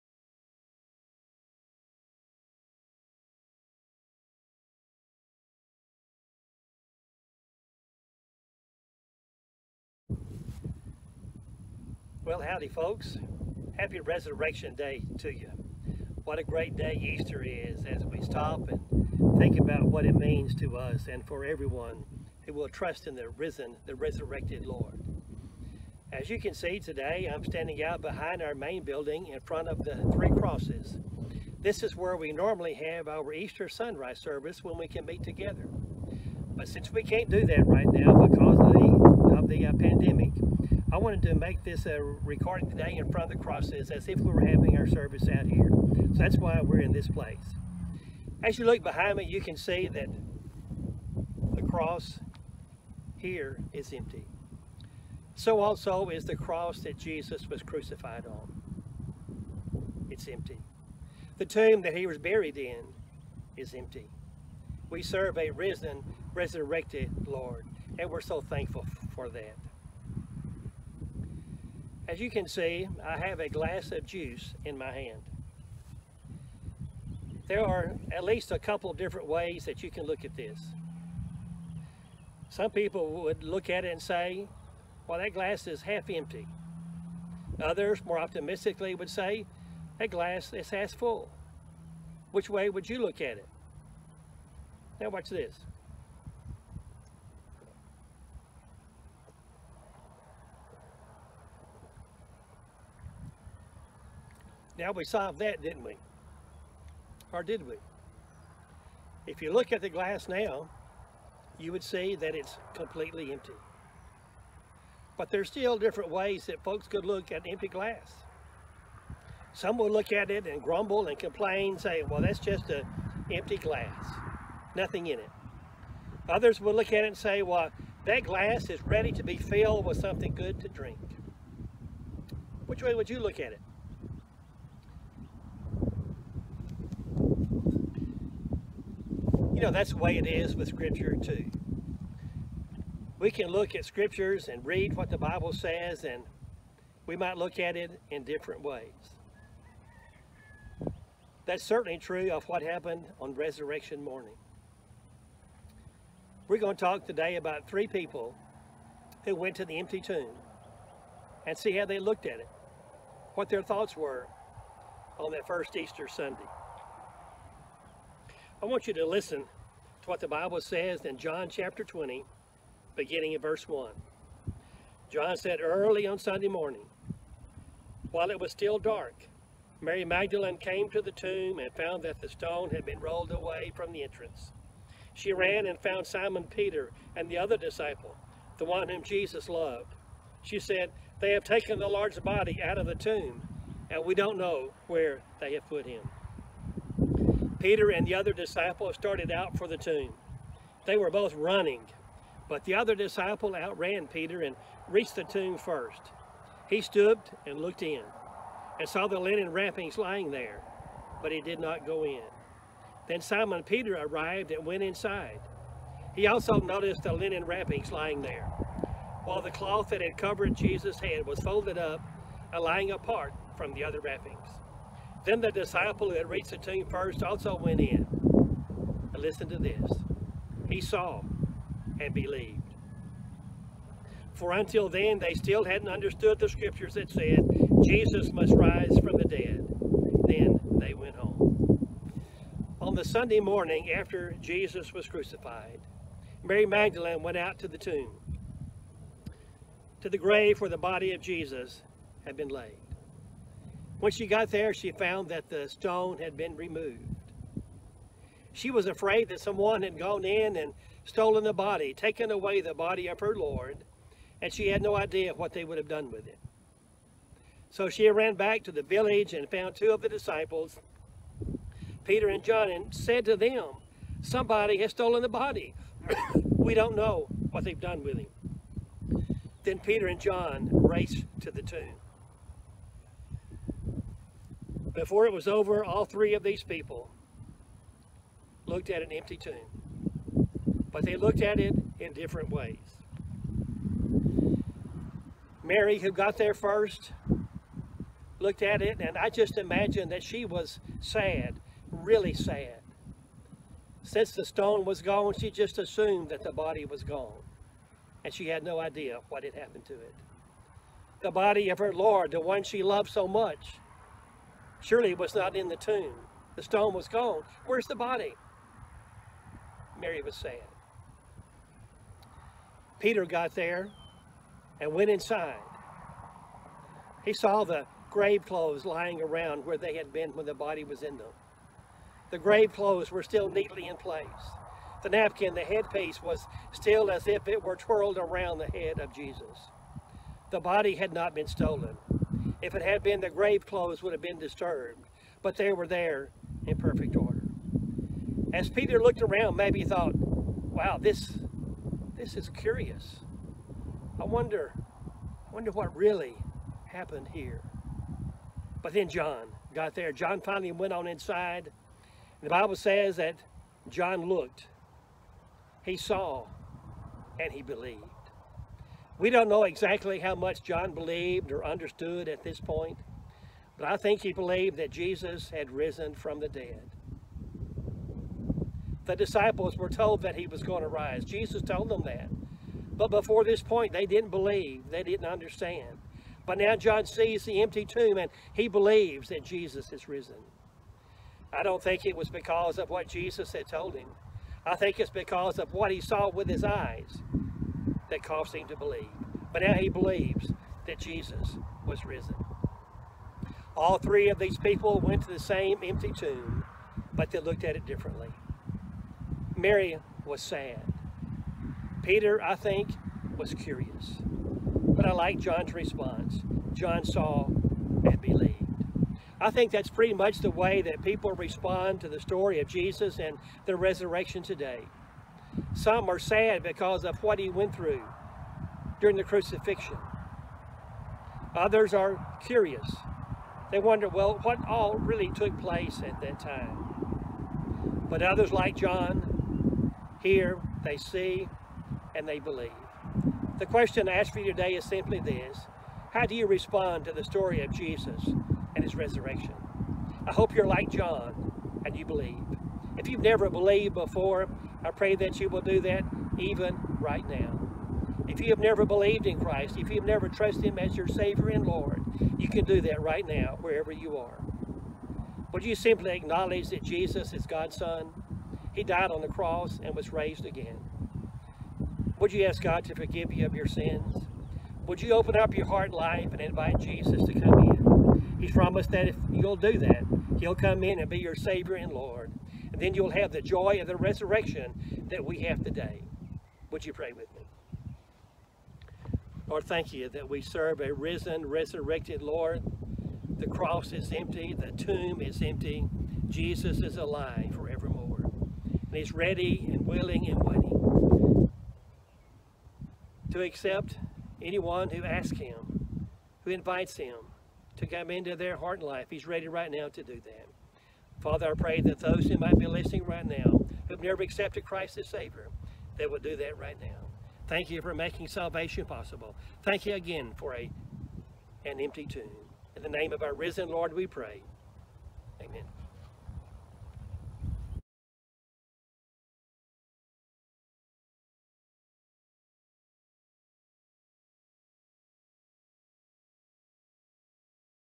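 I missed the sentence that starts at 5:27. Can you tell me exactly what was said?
He saw the grave clothes lying around where they had been when the body was in them.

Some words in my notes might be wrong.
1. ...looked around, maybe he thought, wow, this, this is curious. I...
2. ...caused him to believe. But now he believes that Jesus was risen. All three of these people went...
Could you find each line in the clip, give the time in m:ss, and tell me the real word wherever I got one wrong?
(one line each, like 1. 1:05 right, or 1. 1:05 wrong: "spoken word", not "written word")
1. 5:49 right
2. 6:38 right.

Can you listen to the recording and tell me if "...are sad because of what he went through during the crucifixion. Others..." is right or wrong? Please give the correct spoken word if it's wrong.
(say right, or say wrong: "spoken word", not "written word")
right.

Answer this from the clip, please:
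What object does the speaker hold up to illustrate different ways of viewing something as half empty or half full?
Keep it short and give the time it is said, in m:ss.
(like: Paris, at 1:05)
A glass of juice, at 1:13.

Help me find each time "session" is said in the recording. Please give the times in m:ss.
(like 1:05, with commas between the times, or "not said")
not said.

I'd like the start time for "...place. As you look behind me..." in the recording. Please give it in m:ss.
0:47.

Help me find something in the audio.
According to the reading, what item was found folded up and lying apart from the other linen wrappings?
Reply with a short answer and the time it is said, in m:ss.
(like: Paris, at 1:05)
The cloth that had covered Jesus' head, at 3:39.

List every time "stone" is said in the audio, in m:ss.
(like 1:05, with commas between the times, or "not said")
3:02, 4:15, 5:04, 5:16.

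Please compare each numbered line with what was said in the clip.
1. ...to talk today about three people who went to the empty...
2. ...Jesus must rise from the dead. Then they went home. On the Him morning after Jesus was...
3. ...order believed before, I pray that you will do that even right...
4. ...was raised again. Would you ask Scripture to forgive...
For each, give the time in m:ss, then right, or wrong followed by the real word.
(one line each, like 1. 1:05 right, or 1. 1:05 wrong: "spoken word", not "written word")
1. 2:36 right
2. 3:57 wrong: "Sunday", not "Him"
3. 7:33 wrong: "never", not "order"
4. 7:49 wrong: "God", not "Scripture".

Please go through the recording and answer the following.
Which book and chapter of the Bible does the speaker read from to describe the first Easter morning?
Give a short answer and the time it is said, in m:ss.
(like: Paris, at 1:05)
John chapter 20, at 2:51.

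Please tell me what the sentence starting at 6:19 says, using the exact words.
The disciples were told that he was going to rise.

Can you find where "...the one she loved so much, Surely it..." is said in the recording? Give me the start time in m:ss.
5:12.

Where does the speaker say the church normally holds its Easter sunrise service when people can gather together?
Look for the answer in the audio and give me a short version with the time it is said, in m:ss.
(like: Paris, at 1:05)
In front of the three crosses, at 0:29.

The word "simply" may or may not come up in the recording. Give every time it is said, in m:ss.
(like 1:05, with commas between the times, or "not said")
7:24, 7:45.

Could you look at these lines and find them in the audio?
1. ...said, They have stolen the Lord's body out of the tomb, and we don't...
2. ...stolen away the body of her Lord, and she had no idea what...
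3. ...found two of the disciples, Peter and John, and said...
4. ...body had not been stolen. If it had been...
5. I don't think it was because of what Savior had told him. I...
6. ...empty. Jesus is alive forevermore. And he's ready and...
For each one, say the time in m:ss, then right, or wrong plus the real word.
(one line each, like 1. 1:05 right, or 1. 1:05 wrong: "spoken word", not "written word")
1. 3:10 wrong: "taken", not "stolen"
2. 4:21 wrong: "taken", not "stolen"
3. 4:29 right
4. 5:40 right
5. 6:31 wrong: "Jesus", not "Savior"
6. 8:15 right.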